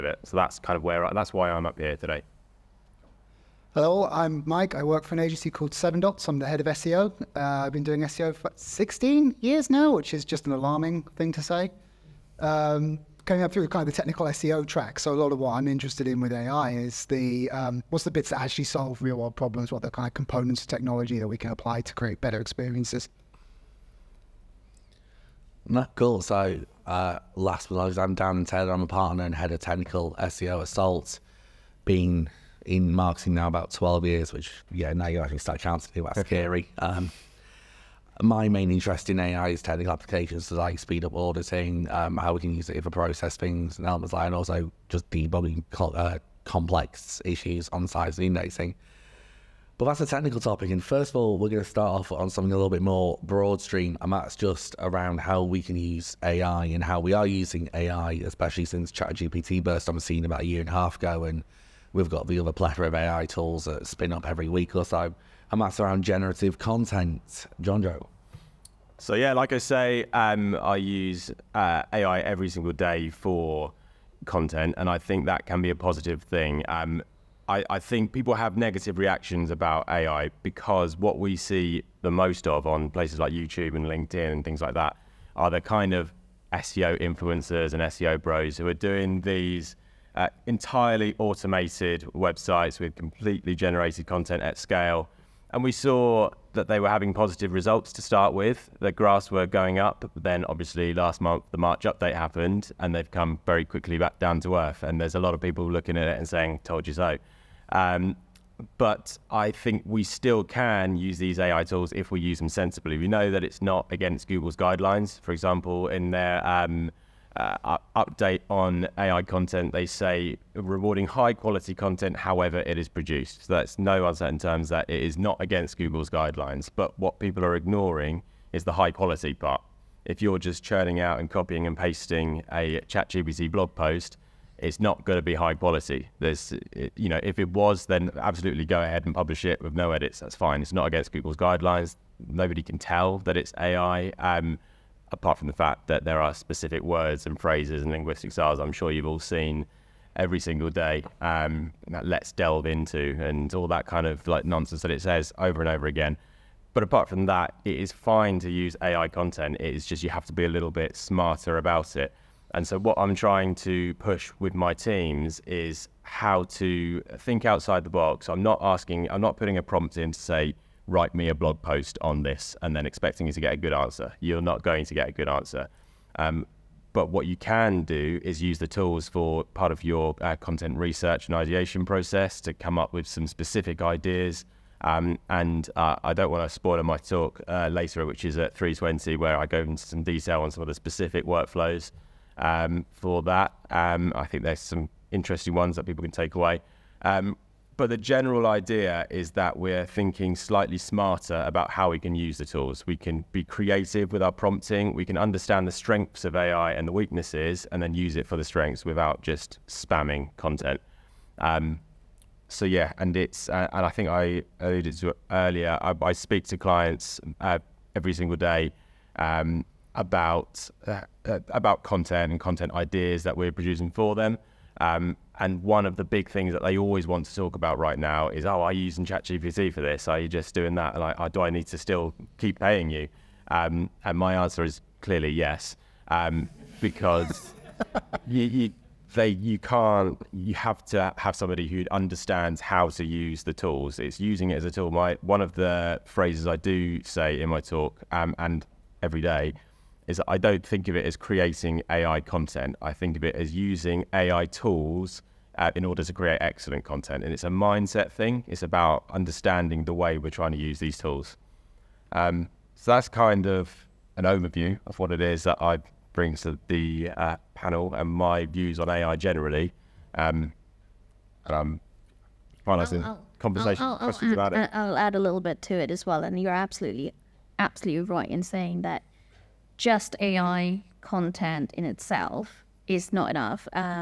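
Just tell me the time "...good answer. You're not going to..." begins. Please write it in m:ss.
2:53.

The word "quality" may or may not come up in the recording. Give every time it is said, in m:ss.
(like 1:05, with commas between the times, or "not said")
2:01, 2:08, 2:15.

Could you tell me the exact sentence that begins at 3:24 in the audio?
We can understand the strengths of AI and the weaknesses and then use it for the strengths without just spamming content.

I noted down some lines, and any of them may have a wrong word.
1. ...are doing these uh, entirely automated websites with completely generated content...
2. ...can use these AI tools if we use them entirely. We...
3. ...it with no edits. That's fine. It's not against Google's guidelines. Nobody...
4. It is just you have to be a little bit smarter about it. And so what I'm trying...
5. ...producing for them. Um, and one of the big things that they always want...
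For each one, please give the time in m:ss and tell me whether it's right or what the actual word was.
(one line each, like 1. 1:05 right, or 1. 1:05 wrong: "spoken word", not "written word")
1. 1:28 right
2. 1:50 wrong: "sensibly", not "entirely"
3. 2:19 right
4. 2:39 right
5. 3:43 right.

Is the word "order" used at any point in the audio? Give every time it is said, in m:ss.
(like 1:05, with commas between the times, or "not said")
4:15.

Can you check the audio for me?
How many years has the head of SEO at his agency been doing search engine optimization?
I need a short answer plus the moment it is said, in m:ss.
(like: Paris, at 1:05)
16, at 0:08.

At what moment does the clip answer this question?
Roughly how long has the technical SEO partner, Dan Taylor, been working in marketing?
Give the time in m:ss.
0:33.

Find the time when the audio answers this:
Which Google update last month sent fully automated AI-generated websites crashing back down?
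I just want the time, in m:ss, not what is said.
1:41.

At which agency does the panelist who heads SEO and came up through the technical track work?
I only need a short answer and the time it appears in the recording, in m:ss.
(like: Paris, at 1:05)
Seven Dots, at 0:05.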